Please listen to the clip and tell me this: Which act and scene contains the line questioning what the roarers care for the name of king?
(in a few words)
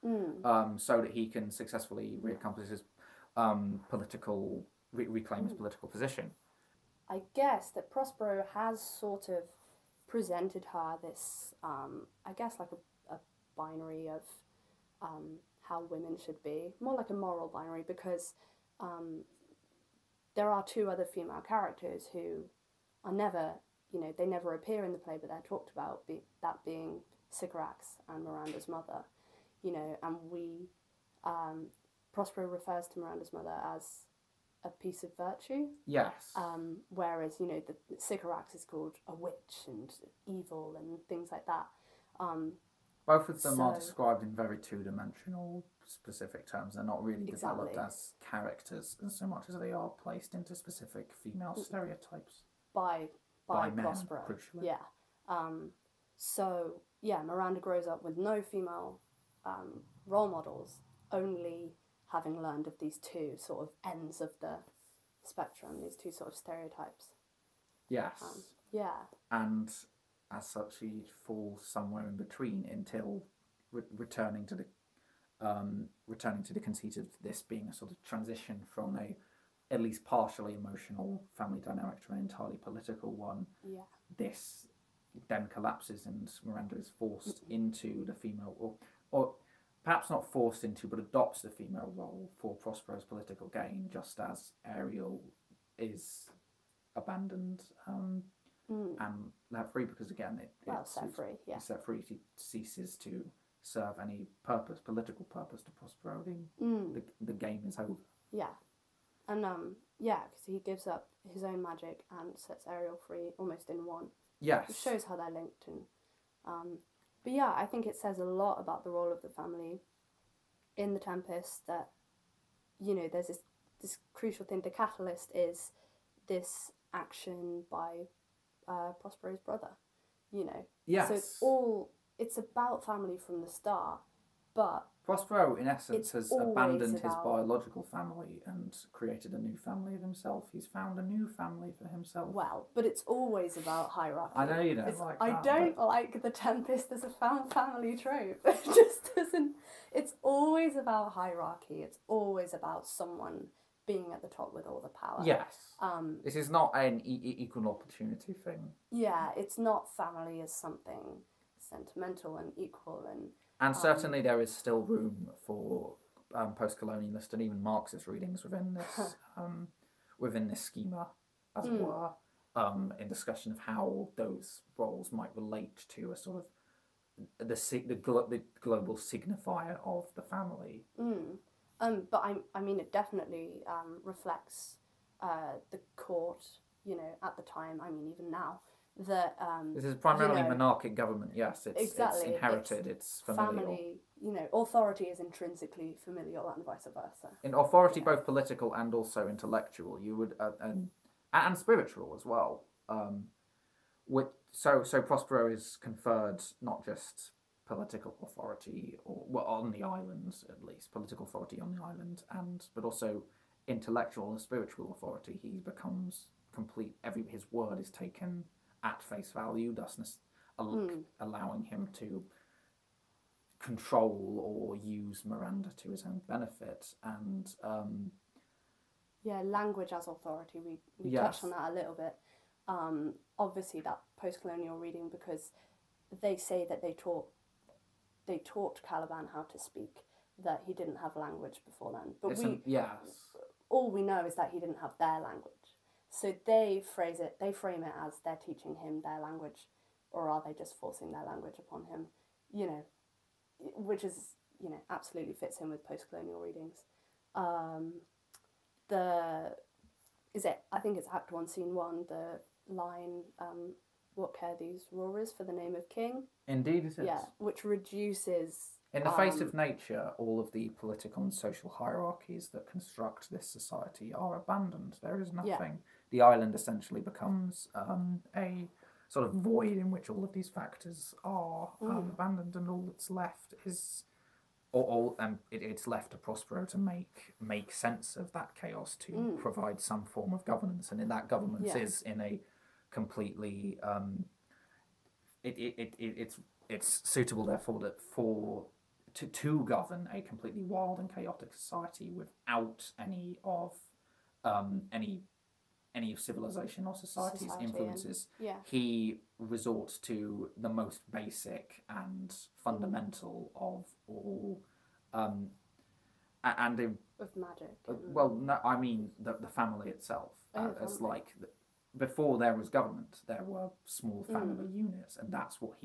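Act One, Scene One.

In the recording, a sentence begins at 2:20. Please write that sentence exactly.
He's found a new family for himself.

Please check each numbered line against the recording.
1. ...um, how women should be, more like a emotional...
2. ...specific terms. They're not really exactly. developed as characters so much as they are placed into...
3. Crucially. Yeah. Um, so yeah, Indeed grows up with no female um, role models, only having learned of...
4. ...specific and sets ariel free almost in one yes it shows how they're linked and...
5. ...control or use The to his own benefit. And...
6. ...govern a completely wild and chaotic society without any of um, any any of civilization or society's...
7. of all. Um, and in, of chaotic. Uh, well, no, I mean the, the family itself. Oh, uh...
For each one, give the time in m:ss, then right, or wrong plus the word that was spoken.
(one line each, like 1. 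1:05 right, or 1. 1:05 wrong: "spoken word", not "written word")
1. 0:15 wrong: "moral", not "emotional"
2. 0:45 right
3. 0:54 wrong: "Miranda", not "Indeed"
4. 1:51 wrong: "magic", not "specific"
5. 3:43 wrong: "Miranda", not "The"
6. 4:59 right
7. 5:13 wrong: "magic", not "chaotic".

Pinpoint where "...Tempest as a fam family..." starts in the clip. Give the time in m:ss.
2:26.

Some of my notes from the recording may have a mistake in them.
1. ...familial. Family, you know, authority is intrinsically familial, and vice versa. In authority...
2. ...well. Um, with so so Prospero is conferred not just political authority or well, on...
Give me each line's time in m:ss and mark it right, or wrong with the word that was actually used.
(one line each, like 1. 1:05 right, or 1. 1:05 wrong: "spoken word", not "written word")
1. 3:13 right
2. 3:22 right.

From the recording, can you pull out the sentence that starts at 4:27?
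Yeah, which reduces in the face of um, nature, all of the political and social hierarchies that construct this society are abandoned.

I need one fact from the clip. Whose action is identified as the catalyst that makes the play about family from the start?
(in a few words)
Prospero's brother.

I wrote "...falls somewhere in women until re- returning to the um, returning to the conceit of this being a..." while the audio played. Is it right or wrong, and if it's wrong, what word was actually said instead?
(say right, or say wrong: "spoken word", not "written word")
wrong: "between", not "women".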